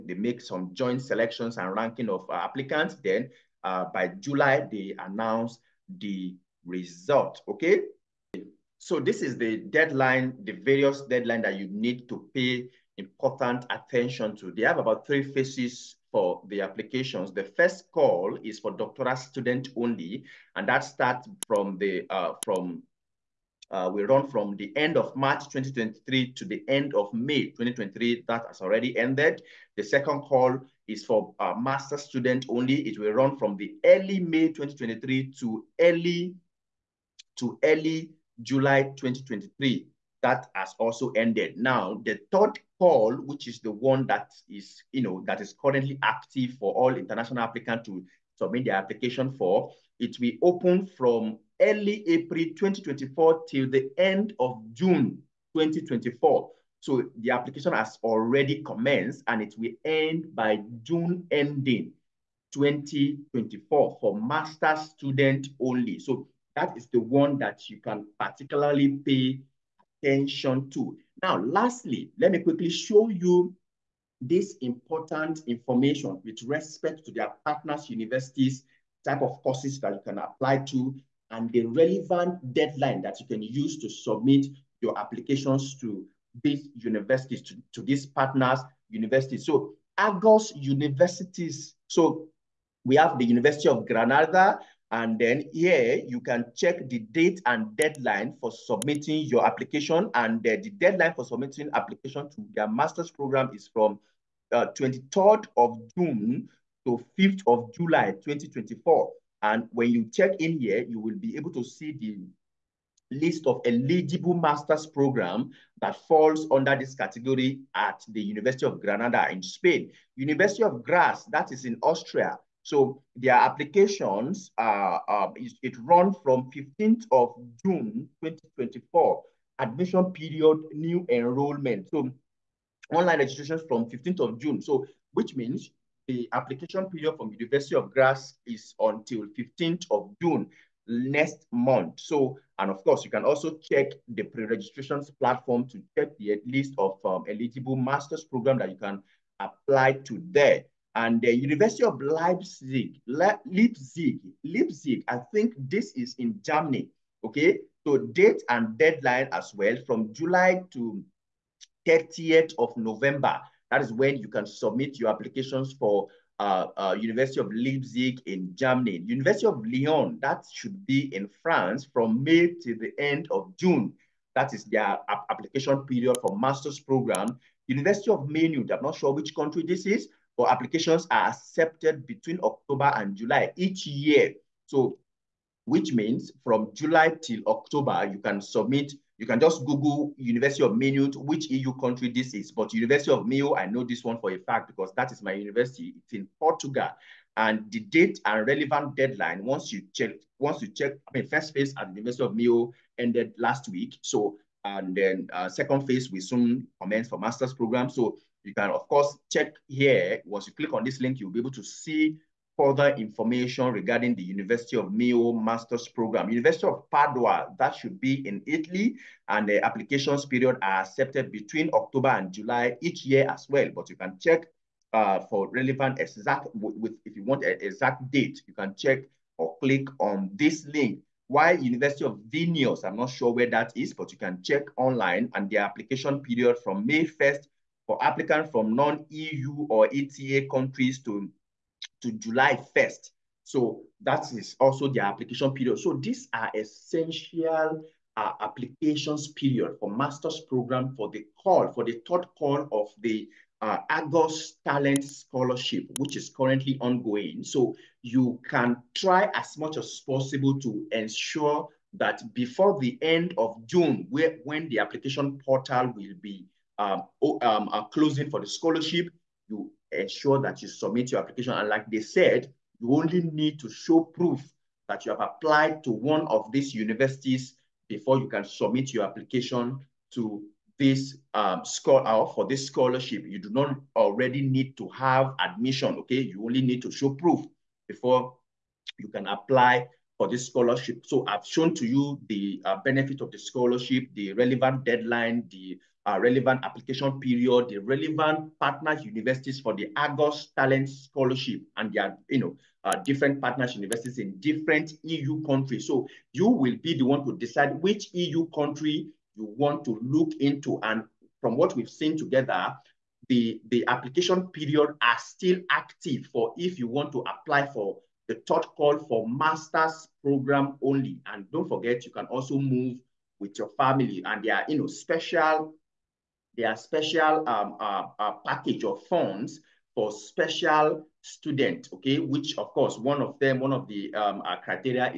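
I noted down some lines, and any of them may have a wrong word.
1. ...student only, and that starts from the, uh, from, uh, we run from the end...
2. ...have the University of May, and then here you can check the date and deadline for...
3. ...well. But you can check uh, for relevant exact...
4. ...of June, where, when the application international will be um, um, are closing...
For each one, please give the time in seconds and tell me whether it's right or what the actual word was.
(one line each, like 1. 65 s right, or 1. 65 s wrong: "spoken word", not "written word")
1. 19 s right
2. 92 s wrong: "Granada", not "May"
3. 223 s right
4. 263 s wrong: "portal", not "international".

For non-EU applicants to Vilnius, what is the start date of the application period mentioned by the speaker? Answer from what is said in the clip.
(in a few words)
May 1.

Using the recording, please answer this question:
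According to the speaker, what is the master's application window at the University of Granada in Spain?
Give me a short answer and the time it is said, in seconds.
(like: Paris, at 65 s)
23 June to 5 July 2024, at 104 s.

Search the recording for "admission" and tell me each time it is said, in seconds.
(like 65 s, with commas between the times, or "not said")
129 s, 285 s.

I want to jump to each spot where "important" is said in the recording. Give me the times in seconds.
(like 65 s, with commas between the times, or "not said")
12 s, 74 s.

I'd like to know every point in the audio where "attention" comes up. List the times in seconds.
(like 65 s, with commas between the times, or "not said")
13 s, 70 s.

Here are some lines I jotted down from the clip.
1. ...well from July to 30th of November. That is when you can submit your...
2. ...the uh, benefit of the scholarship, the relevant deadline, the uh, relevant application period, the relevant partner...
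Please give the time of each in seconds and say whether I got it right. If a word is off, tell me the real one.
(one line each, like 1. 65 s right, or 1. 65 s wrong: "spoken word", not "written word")
1. 159 s right
2. 292 s right.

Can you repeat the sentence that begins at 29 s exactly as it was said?
The second call is for uh, master student only.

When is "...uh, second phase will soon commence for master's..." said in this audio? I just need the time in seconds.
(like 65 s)
205 s.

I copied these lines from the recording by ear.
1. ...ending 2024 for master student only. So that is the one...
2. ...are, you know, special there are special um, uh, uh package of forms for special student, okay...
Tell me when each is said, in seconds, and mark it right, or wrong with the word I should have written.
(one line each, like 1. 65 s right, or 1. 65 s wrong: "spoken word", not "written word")
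1. 61 s right
2. 324 s right.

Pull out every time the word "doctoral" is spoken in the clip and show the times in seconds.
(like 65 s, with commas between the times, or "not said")
18 s.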